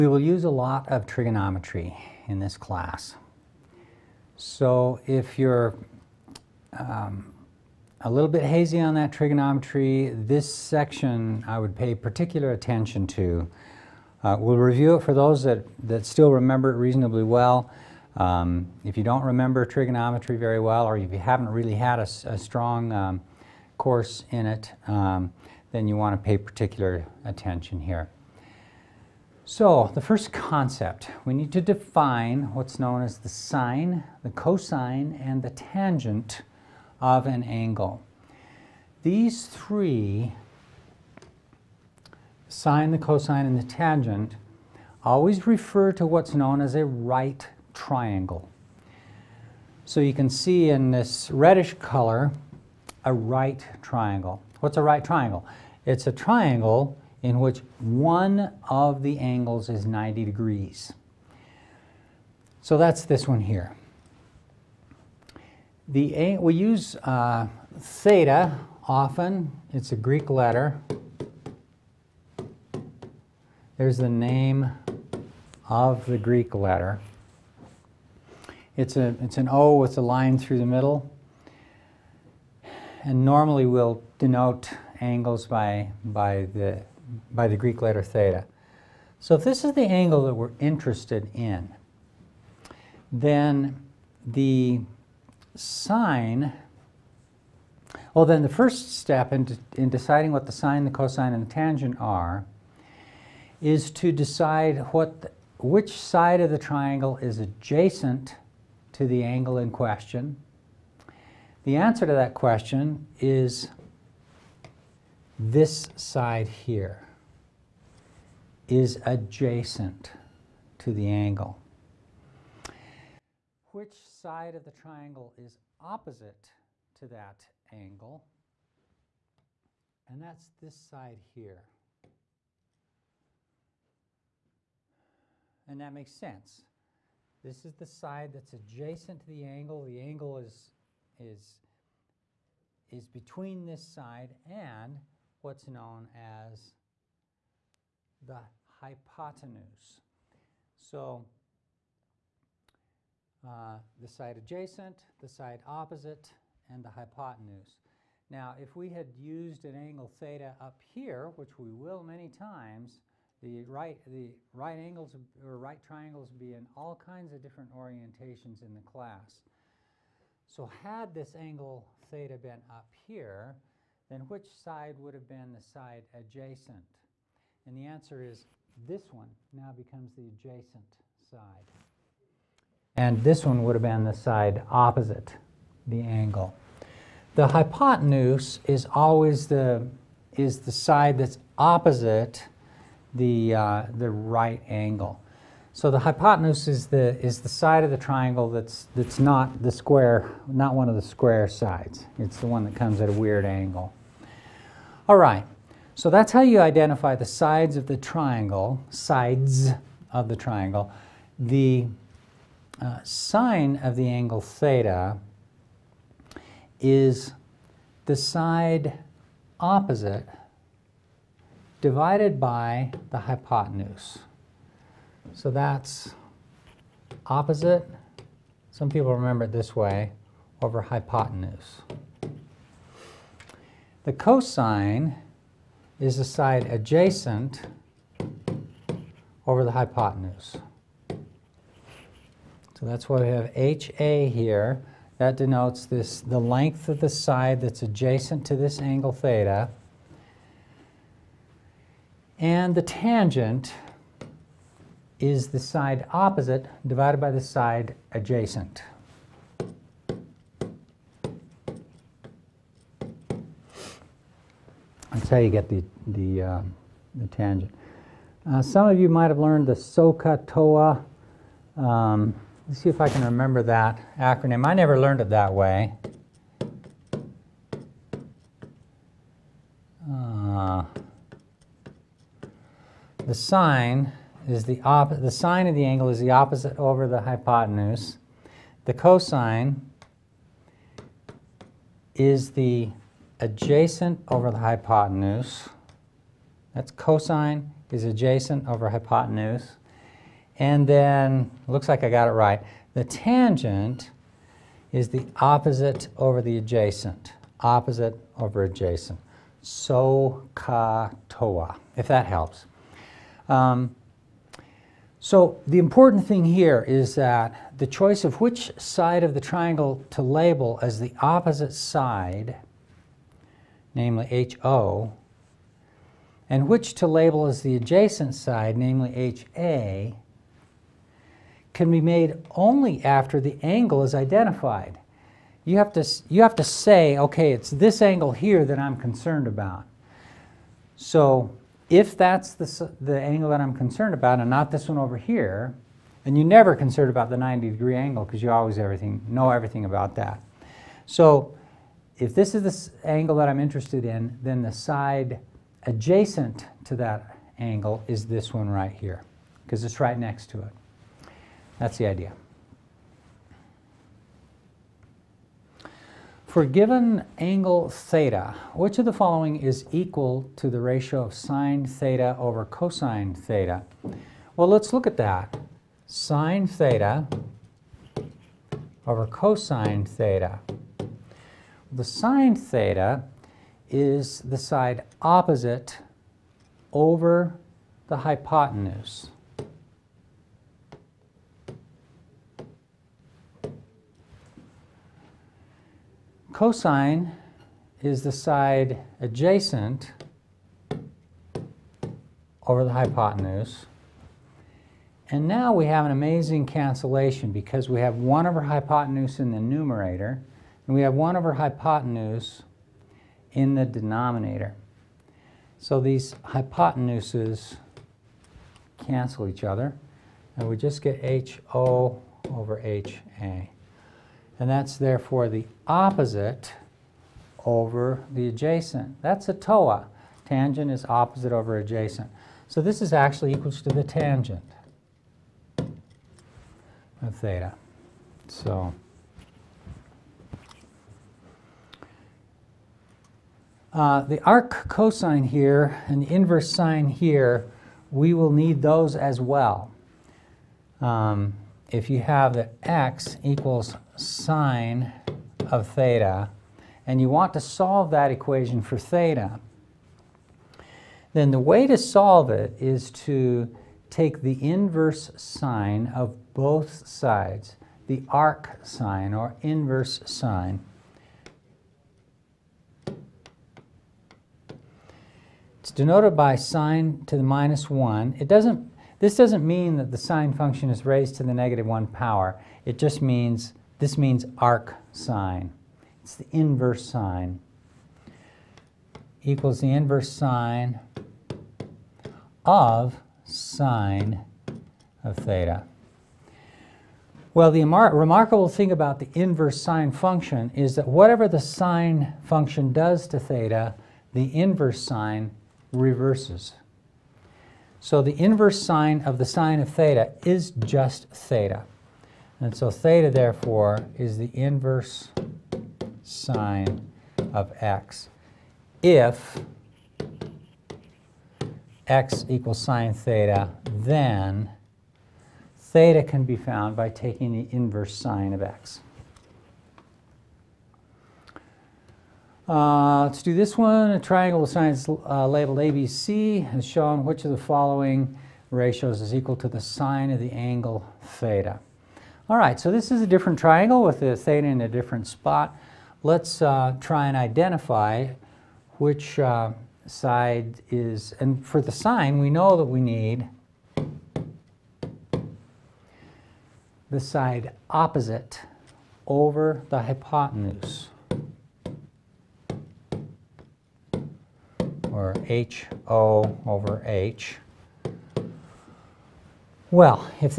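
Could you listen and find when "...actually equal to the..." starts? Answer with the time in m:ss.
7:13.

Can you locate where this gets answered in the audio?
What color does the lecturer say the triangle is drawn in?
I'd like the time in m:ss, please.
0:51.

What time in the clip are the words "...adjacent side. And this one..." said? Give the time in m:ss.
3:00.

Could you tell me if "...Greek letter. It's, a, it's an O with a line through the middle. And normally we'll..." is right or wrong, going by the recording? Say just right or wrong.
right.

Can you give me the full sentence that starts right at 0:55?
It's a triangle in which one of the angles is 90 degrees.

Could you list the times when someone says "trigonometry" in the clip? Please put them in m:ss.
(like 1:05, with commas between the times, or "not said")
0:01, 0:09, 0:19.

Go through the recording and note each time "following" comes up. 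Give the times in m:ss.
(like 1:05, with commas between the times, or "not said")
6:09, 8:57.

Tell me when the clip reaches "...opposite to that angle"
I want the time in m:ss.
2:05.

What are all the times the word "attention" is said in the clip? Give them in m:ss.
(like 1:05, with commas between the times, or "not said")
0:12, 0:27.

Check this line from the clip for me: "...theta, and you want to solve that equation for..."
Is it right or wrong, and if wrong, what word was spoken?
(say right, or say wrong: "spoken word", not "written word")
right.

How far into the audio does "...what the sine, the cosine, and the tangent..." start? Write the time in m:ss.
1:40.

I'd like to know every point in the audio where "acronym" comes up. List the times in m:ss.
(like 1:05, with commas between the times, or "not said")
4:34.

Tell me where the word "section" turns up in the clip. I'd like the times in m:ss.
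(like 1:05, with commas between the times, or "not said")
0:10.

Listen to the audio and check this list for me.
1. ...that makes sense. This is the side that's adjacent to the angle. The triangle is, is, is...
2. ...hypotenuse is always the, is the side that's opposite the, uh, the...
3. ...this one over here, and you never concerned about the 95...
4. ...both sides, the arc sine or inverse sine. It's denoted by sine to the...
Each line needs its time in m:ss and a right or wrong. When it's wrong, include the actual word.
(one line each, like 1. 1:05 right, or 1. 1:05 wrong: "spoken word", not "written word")
1. 2:15 wrong: "angle", not "triangle"
2. 3:07 right
3. 5:44 wrong: "90", not "95"
4. 7:46 right.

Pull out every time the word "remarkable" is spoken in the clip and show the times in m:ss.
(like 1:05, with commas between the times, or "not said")
8:17.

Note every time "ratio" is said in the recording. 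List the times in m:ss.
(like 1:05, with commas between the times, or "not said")
6:10, 8:58.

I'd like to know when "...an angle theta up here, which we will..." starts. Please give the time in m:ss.
2:39.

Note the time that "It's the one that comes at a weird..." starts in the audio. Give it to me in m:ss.
3:22.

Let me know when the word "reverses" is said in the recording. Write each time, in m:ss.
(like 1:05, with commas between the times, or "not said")
8:25.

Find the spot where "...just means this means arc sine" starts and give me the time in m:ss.
8:02.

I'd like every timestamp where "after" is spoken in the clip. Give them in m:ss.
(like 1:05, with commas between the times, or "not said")
5:33.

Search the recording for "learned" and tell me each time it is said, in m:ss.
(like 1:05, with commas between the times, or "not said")
4:29, 4:34.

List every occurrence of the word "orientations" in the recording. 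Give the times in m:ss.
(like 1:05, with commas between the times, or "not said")
2:47.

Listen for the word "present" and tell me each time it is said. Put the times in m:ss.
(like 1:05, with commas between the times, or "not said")
not said.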